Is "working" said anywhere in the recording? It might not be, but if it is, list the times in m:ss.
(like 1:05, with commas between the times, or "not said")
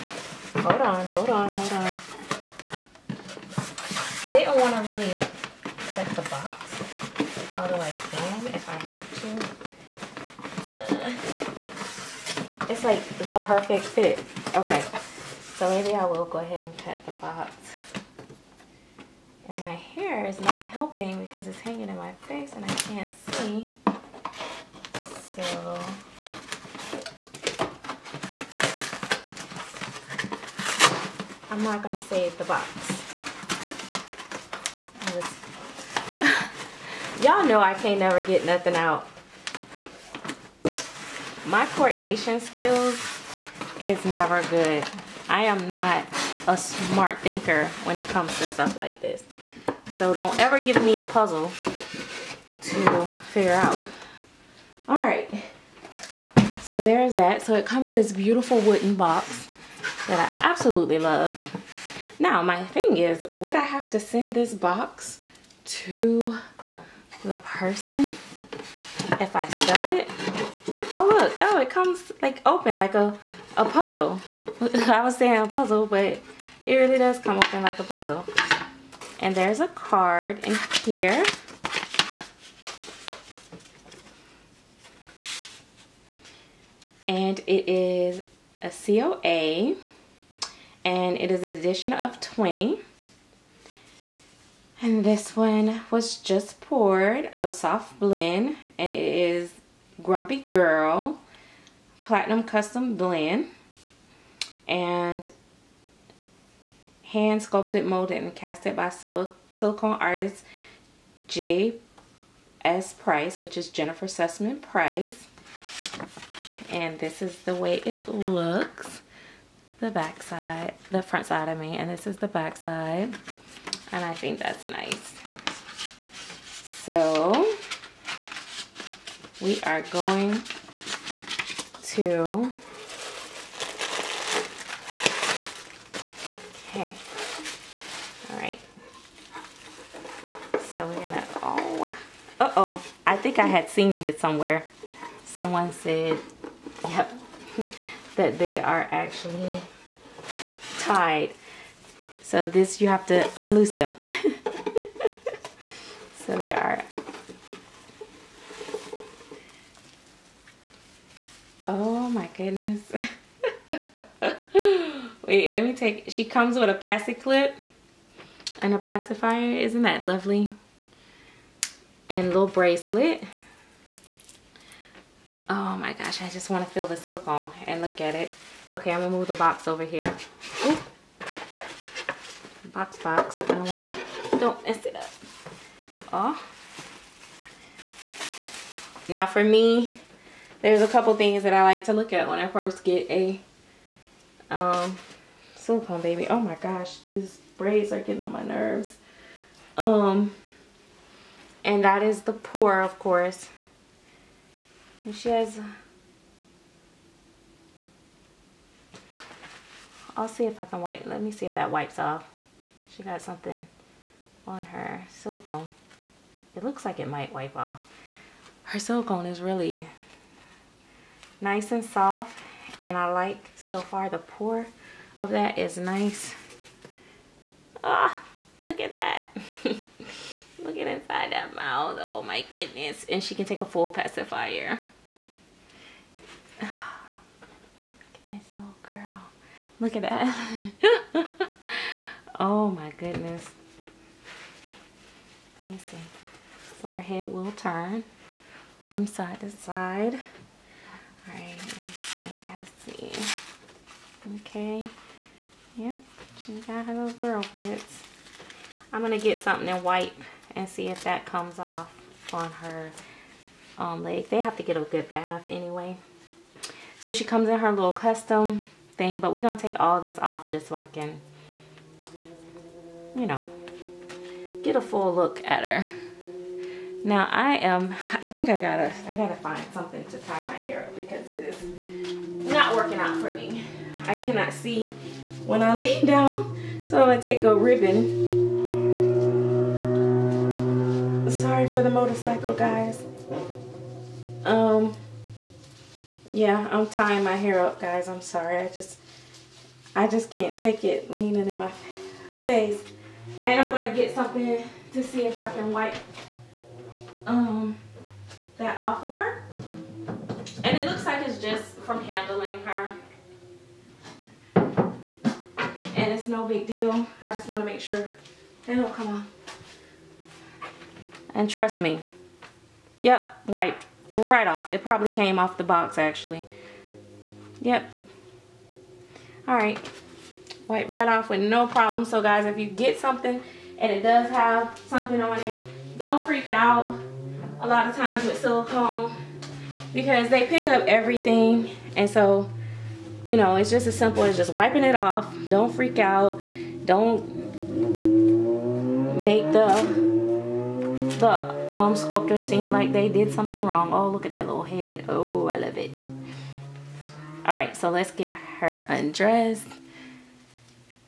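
4:42.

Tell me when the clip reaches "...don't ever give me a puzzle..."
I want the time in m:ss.
0:50.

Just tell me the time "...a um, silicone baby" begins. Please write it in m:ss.
3:13.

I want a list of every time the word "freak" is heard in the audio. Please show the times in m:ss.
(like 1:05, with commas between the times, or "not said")
5:36, 5:45.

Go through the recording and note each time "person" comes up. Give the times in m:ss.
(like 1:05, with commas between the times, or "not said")
1:07.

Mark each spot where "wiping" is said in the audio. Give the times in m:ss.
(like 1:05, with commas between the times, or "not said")
5:44.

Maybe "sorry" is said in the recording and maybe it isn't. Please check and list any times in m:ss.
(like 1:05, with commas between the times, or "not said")
4:51, 4:58.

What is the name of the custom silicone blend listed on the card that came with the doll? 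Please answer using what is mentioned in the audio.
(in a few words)
Grumpy Girl Platinum.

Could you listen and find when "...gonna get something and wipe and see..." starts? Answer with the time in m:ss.
4:19.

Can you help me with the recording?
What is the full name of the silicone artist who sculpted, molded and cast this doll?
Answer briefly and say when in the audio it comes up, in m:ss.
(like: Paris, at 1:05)
Jennifer Sussman Price, at 1:53.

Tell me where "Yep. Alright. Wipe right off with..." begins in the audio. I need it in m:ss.
5:27.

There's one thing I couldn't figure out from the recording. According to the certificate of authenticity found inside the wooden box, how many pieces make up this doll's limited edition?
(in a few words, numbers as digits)
20.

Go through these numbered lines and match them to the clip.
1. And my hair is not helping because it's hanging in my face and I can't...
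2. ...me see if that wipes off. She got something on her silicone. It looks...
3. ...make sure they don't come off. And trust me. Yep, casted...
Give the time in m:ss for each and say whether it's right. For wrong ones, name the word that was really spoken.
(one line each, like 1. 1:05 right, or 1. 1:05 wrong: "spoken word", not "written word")
1. 0:19 right
2. 3:31 right
3. 5:17 wrong: "wiped", not "casted".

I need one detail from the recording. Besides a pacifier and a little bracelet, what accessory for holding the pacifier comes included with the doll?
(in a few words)
passy clip.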